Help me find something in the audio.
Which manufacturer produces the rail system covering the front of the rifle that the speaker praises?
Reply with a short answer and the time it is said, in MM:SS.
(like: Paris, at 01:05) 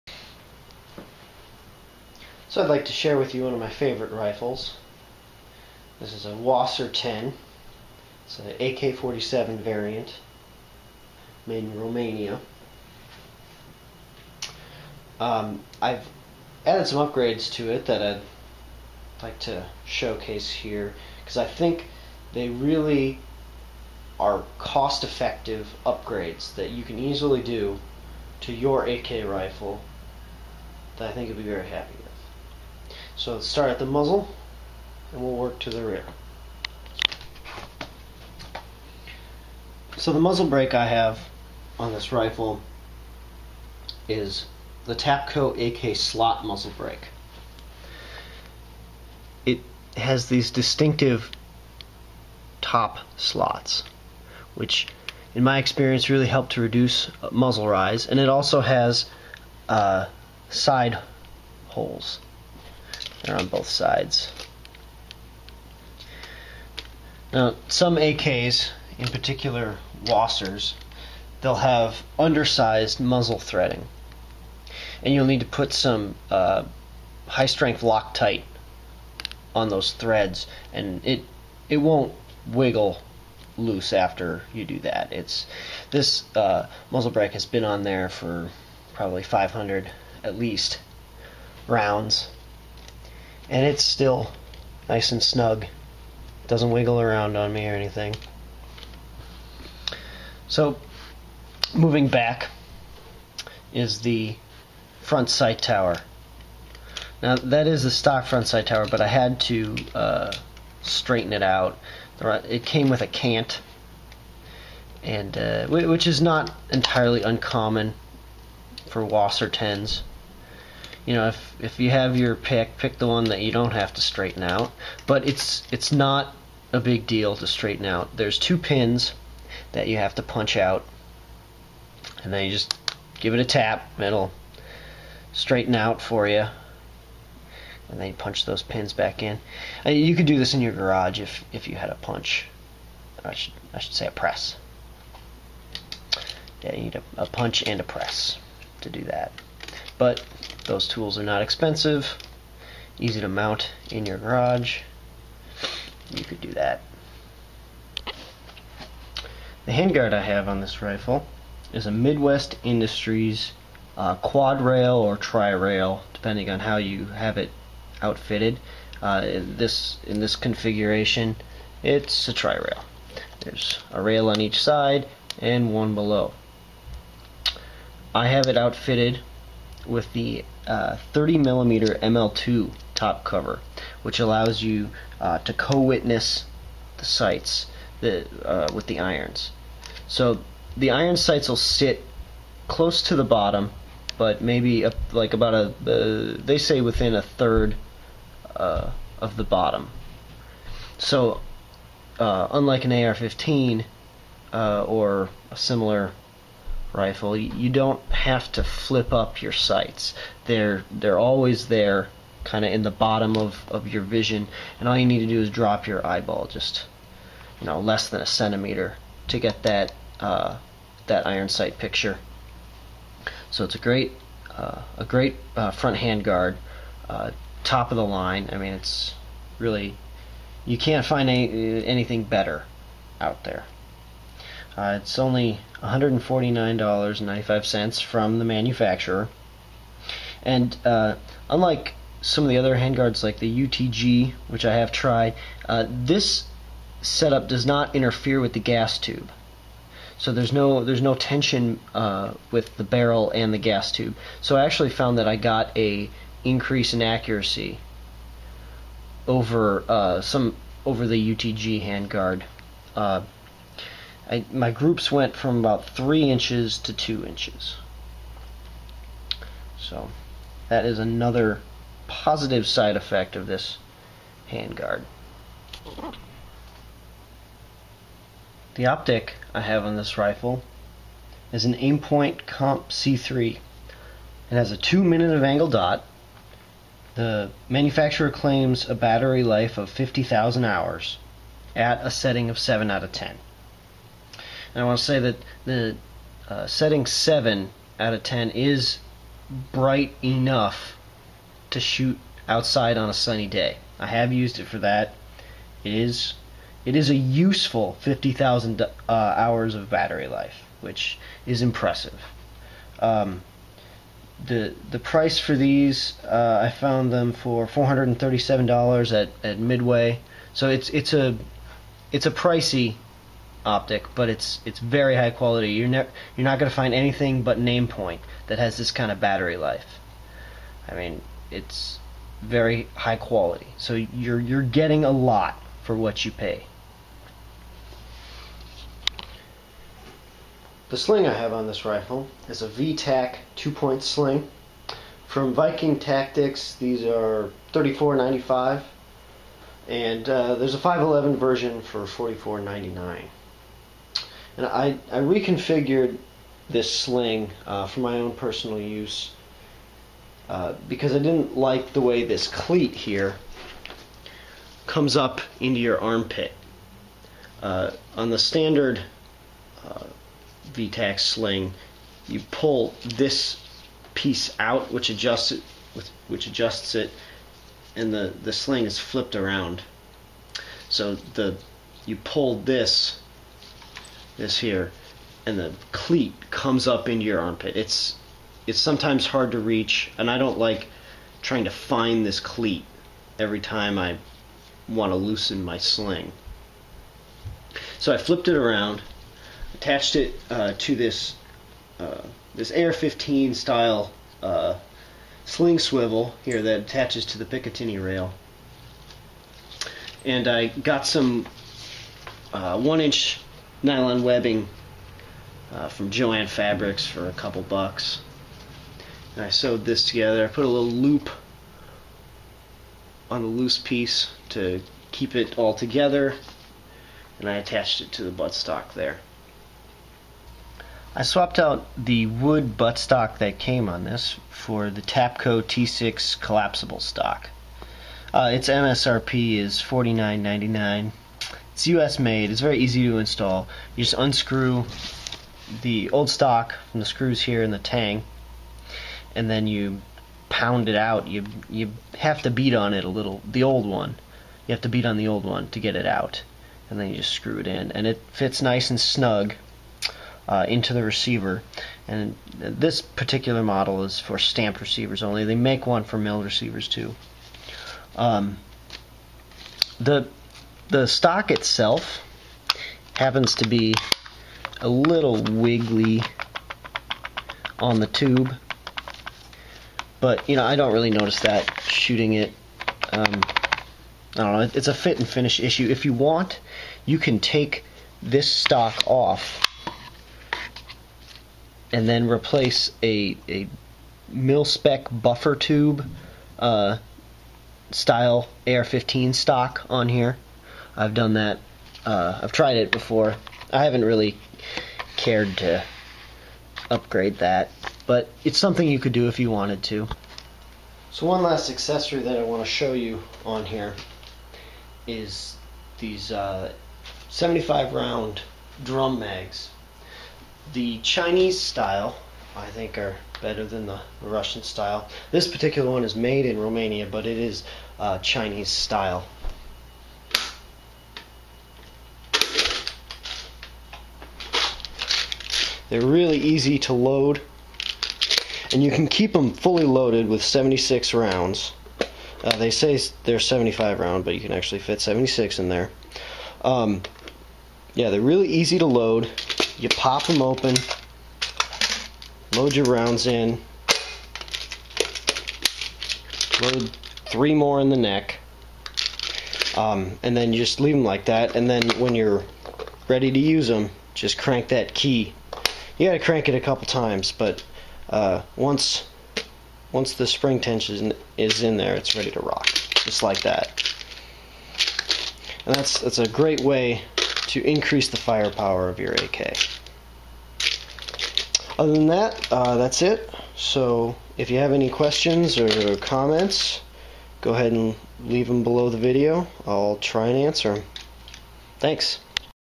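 Midwest Industries, at 02:41.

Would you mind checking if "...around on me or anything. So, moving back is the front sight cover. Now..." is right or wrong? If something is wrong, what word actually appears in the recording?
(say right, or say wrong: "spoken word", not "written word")
wrong: "tower", not "cover".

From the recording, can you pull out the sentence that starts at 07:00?
I put a little loop on the loose piece to keep it all together and I attached it to the buttstock there.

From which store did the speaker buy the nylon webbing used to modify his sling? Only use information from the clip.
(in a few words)
Joann Fabrics.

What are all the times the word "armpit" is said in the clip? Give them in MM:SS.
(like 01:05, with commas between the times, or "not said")
06:06, 06:27.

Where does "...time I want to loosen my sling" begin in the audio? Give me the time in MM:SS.
06:33.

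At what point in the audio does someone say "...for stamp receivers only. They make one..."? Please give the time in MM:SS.
07:44.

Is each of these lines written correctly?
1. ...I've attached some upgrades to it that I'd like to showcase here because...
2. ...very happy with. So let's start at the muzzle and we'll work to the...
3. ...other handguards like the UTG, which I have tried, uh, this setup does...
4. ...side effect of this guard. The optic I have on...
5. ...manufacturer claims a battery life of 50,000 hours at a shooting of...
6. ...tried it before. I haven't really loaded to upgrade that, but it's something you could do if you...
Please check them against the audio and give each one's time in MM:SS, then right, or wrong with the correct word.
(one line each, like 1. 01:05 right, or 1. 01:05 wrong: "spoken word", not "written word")
1. 00:15 wrong: "added", not "attached"
2. 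00:31 right
3. 04:02 right
4. 04:32 wrong: "handguard", not "guard"
5. 04:47 wrong: "setting", not "shooting"
6. 08:22 wrong: "cared", not "loaded".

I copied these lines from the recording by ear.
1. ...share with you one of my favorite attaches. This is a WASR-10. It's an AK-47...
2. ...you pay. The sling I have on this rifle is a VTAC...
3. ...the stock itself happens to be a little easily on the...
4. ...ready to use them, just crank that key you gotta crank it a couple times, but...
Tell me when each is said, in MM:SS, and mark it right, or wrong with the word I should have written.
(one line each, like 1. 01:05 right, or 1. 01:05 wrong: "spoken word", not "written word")
1. 00:02 wrong: "rifles", not "attaches"
2. 05:36 right
3. 07:50 wrong: "wiggly", not "easily"
4. 09:23 right.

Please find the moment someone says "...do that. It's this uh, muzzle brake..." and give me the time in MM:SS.
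01:24.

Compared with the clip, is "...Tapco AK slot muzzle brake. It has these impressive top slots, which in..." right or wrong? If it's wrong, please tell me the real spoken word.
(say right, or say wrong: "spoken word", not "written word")
wrong: "distinctive", not "impressive".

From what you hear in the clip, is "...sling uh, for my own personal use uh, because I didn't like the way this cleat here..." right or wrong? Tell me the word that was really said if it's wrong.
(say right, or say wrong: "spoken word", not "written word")
right.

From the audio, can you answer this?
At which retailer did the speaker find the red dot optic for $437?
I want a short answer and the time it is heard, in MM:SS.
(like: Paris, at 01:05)
Midway, at 05:19.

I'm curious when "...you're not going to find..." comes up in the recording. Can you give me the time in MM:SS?
05:26.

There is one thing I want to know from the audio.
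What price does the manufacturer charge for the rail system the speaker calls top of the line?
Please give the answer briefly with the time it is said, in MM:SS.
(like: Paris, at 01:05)
$149.95, at 03:55.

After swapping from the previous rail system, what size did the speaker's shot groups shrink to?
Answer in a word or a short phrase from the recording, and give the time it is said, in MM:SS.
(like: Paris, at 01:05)
2 inches, at 04:26.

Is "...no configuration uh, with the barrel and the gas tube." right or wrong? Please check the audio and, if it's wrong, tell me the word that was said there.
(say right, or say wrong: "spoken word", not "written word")
wrong: "tension", not "configuration".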